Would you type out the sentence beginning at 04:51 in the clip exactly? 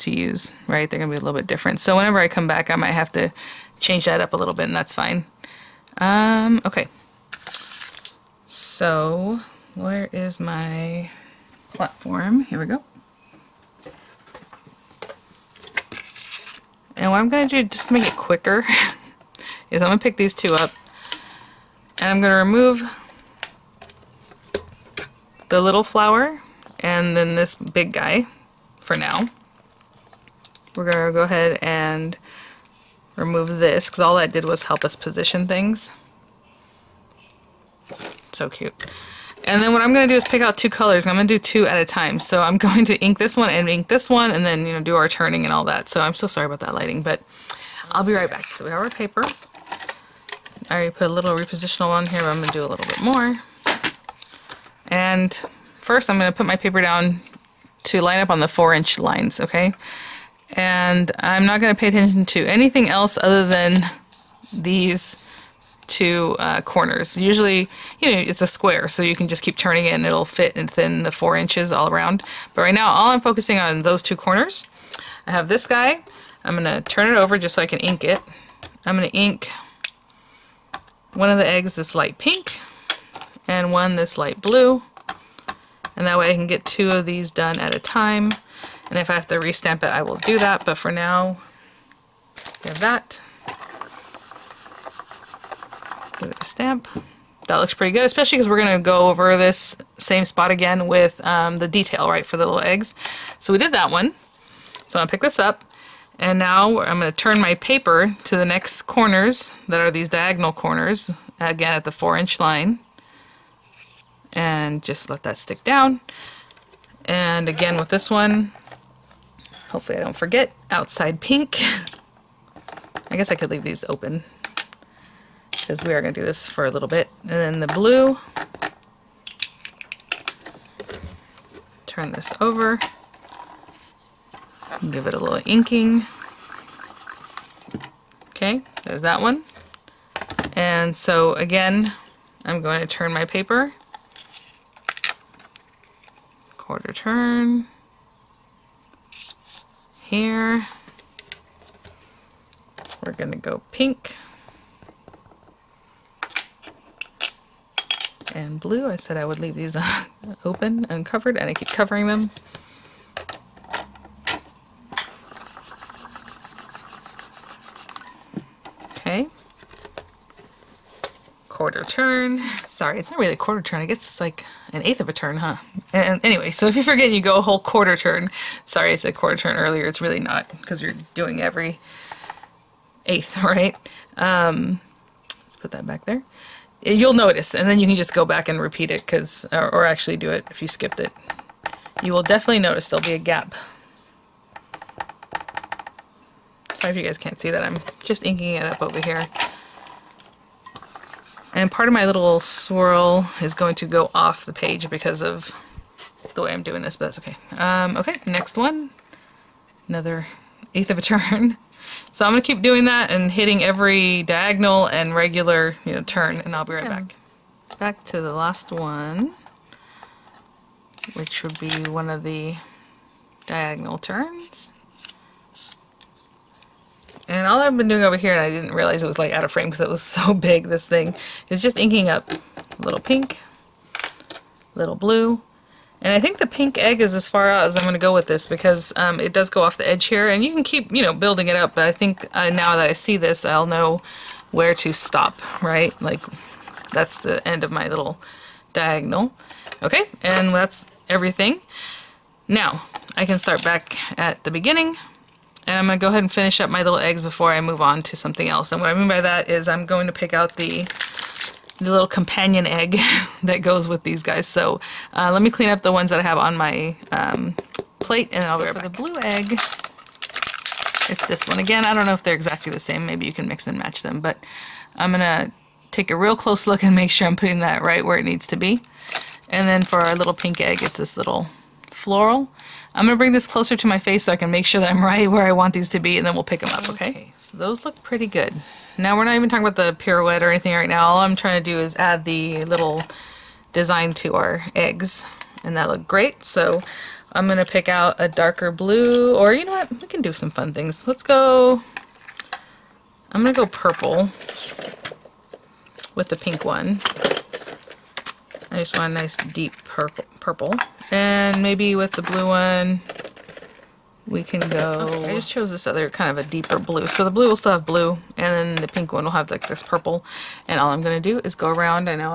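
All I'm trying to do is add the little design to our eggs, and that looked great.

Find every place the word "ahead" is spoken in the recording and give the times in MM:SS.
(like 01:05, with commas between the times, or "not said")
00:31, 04:16.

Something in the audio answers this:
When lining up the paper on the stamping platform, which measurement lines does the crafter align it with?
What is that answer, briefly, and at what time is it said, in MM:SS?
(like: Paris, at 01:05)
4 inch lines, at 00:58.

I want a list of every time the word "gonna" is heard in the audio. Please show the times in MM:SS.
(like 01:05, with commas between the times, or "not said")
01:38, 01:45.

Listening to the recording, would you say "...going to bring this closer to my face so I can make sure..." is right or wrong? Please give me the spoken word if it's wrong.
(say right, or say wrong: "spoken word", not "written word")
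right.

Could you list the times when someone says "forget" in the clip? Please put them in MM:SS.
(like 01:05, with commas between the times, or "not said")
02:00, 02:56.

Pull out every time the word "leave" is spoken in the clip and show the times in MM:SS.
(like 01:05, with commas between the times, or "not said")
02:03, 02:39.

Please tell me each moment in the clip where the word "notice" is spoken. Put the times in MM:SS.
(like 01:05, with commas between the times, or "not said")
03:07, 03:12.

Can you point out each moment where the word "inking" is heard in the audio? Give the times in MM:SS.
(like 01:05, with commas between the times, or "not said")
02:15, 03:18, 03:51.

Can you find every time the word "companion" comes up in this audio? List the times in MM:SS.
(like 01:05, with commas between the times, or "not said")
04:22.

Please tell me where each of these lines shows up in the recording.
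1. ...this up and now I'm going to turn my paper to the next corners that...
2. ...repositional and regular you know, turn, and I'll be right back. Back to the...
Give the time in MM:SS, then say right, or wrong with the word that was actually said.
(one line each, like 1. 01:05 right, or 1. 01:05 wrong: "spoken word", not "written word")
1. 01:45 right
2. 03:34 wrong: "diagonal", not "repositional".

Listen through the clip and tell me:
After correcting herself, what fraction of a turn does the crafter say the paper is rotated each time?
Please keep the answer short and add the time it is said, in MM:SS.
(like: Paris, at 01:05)
an eighth, at 02:54.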